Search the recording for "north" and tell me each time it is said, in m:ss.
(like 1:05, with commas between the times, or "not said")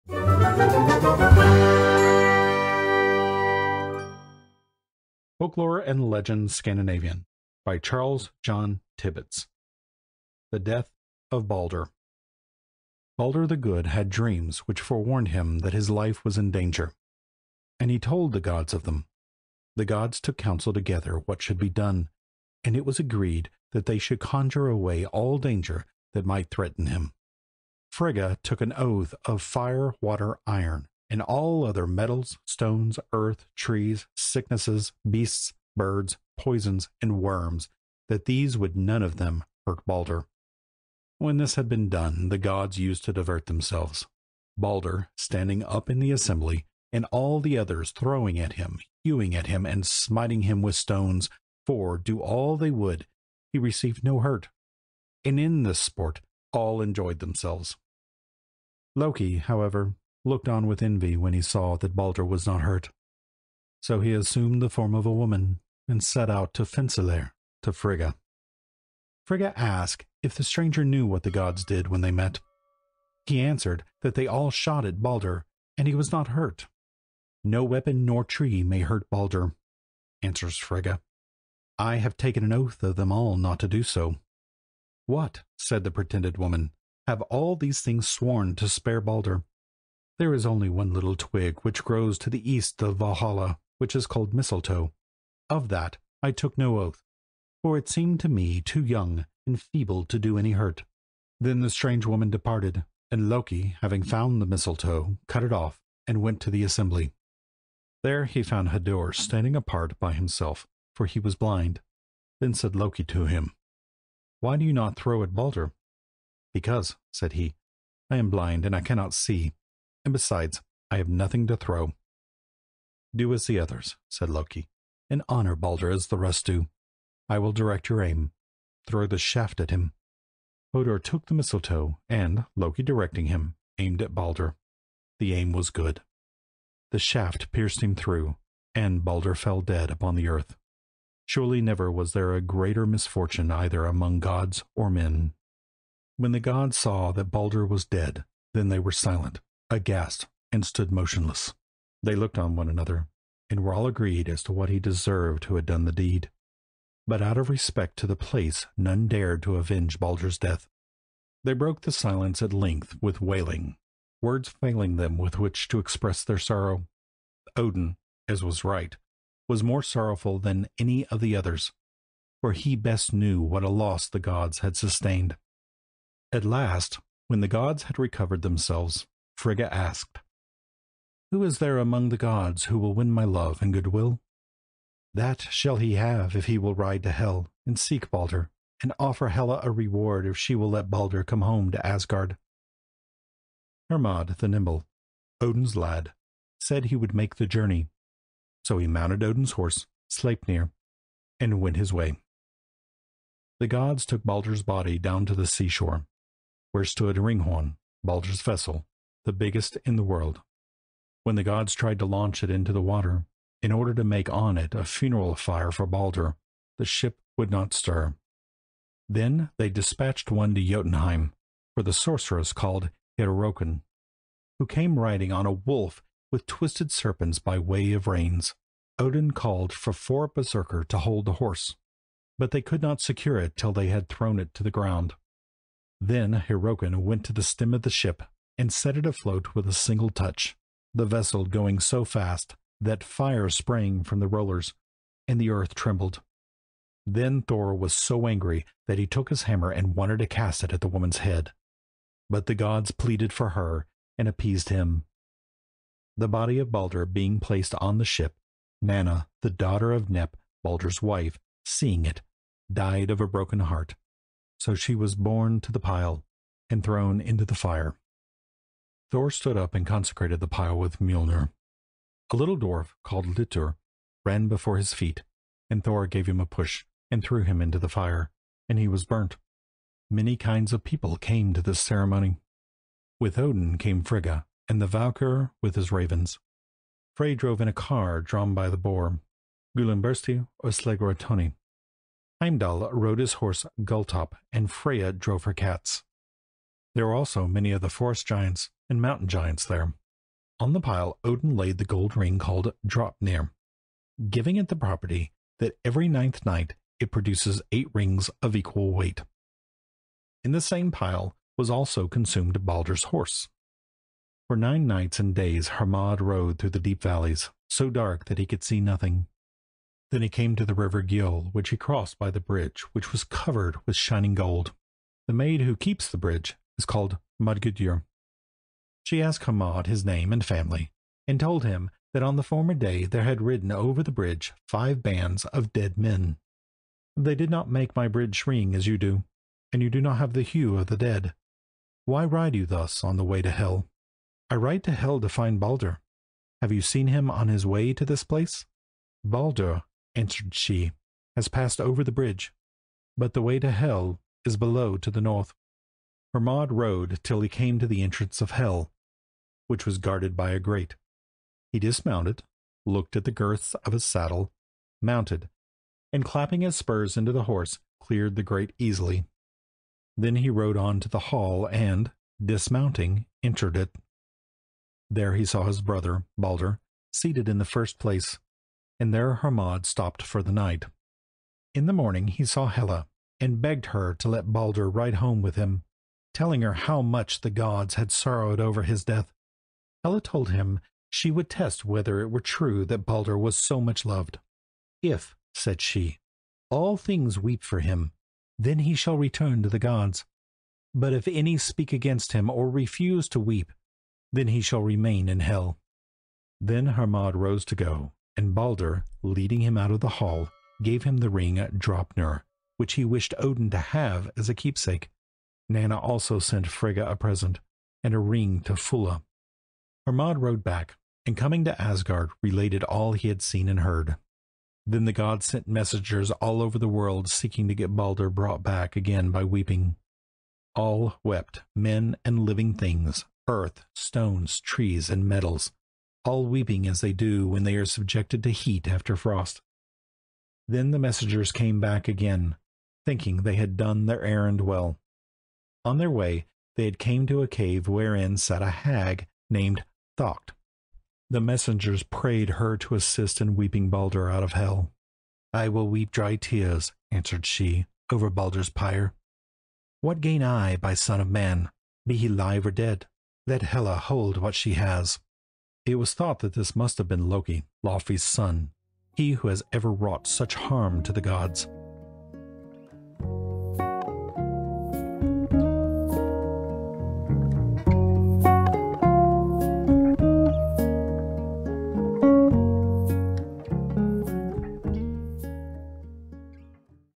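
5:55.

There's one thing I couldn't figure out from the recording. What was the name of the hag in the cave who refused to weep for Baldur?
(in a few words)
Thaukt.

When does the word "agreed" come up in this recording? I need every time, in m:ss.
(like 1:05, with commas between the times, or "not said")
0:22, 2:33.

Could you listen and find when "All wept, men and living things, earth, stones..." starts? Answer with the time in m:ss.
7:10.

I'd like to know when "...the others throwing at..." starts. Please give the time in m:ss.
0:47.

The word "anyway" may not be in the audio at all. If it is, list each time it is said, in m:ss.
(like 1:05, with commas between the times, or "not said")
not said.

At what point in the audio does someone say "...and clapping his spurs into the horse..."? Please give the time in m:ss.
6:06.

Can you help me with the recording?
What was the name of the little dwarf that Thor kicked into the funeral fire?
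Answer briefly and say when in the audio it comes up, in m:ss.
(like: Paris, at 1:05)
Litur, at 4:33.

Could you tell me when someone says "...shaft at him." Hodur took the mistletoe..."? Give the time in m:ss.
2:09.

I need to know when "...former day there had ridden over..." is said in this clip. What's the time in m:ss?
5:32.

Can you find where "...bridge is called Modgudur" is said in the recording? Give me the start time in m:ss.
5:26.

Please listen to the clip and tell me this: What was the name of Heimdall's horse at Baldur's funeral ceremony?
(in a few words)
Gultop.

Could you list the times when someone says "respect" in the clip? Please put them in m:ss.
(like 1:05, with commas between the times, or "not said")
2:37.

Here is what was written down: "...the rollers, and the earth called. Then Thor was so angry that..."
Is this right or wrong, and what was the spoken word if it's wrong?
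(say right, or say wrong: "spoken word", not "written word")
wrong: "trembled", not "called".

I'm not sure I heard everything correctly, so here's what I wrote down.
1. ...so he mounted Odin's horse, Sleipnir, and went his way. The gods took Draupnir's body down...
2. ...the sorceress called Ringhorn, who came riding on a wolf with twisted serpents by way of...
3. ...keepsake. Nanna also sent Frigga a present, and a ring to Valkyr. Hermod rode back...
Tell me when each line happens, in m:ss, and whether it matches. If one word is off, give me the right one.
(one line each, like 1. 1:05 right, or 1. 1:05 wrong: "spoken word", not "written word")
1. 3:18 wrong: "Baldur", not "Draupnir"
2. 3:41 wrong: "Hyrroken", not "Ringhorn"
3. 6:54 wrong: "Fulla", not "Valkyr".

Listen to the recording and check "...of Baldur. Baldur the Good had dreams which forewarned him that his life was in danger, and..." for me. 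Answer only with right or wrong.
right.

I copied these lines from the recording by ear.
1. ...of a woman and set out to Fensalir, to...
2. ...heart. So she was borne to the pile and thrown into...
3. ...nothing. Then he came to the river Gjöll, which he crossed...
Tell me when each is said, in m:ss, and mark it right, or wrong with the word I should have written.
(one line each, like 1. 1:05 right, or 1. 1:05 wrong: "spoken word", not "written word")
1. 1:04 right
2. 4:23 right
3. 5:18 right.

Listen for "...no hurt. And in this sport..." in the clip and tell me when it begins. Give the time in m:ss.
0:54.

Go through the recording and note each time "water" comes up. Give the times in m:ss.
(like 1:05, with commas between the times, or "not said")
0:30, 3:32.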